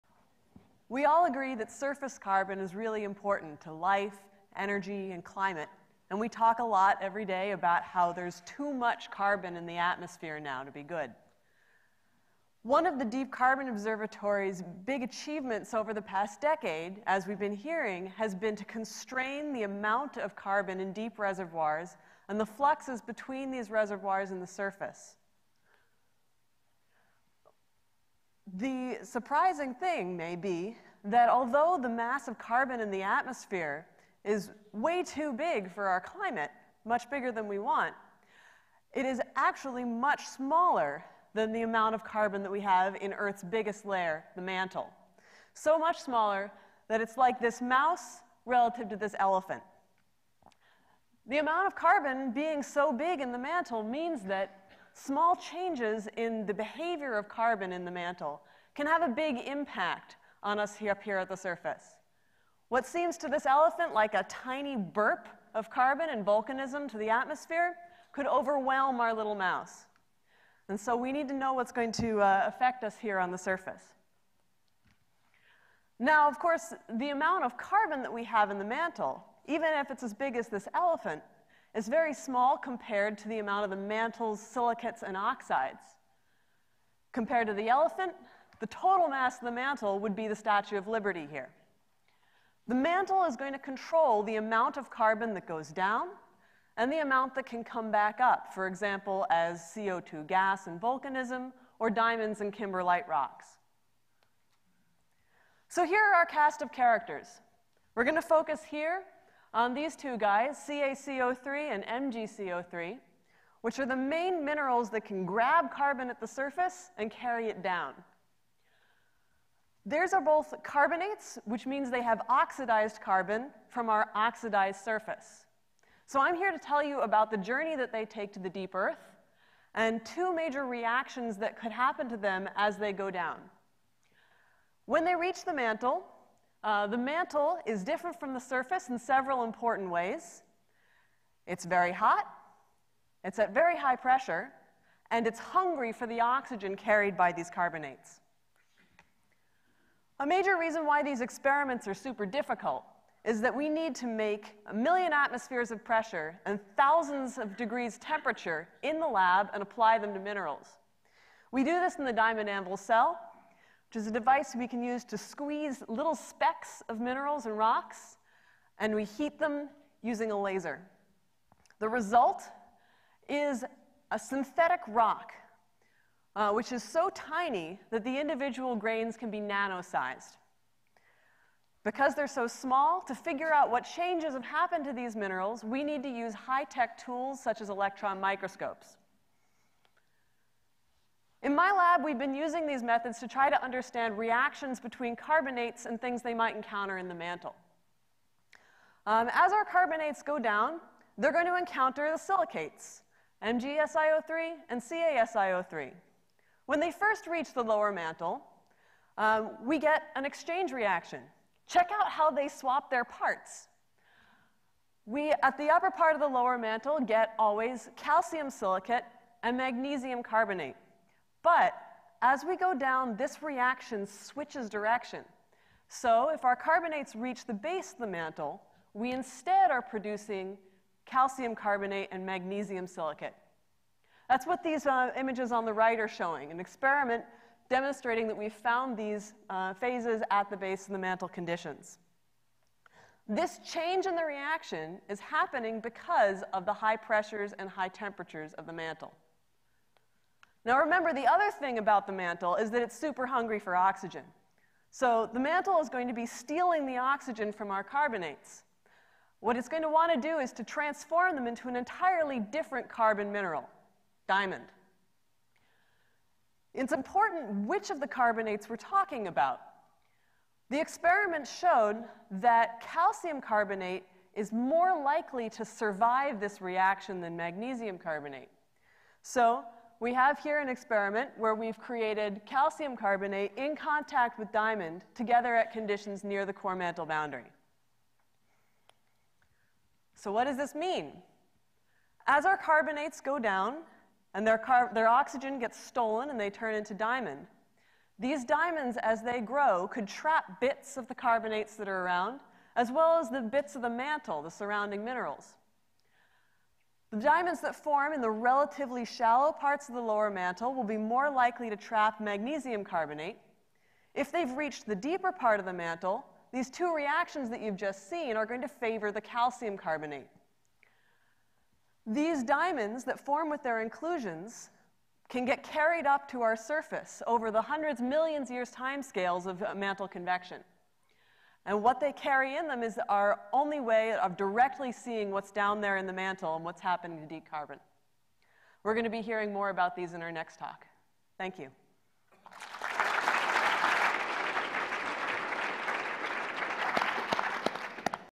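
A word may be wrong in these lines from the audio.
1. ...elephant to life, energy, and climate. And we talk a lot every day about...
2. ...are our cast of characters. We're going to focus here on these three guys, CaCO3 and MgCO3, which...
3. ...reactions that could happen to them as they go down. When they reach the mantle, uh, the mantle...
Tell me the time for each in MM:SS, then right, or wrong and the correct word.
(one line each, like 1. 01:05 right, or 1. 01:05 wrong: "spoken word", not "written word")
1. 00:03 wrong: "important", not "elephant"
2. 01:46 wrong: "two", not "three"
3. 02:10 right.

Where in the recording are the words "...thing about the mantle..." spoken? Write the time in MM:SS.
04:11.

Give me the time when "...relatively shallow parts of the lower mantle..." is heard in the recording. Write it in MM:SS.
05:08.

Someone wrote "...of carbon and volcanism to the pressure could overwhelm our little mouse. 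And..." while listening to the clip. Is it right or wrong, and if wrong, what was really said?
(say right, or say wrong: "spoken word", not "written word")
wrong: "atmosphere", not "pressure".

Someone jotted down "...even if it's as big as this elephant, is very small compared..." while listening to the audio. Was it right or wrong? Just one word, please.
right.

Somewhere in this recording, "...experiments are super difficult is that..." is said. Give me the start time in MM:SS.
02:31.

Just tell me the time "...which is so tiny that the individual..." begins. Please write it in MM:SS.
02:56.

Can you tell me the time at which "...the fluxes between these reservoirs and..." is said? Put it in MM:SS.
00:22.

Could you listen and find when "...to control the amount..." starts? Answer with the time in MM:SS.
01:33.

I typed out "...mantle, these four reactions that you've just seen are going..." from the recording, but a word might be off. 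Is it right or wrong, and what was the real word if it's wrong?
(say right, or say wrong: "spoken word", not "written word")
wrong: "two", not "four".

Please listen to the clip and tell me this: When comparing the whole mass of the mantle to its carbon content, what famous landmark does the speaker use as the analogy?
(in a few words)
Statue of Liberty.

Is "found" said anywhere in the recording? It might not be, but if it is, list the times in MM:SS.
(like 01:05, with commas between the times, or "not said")
03:58.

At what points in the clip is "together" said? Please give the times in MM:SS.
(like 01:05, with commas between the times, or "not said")
04:45.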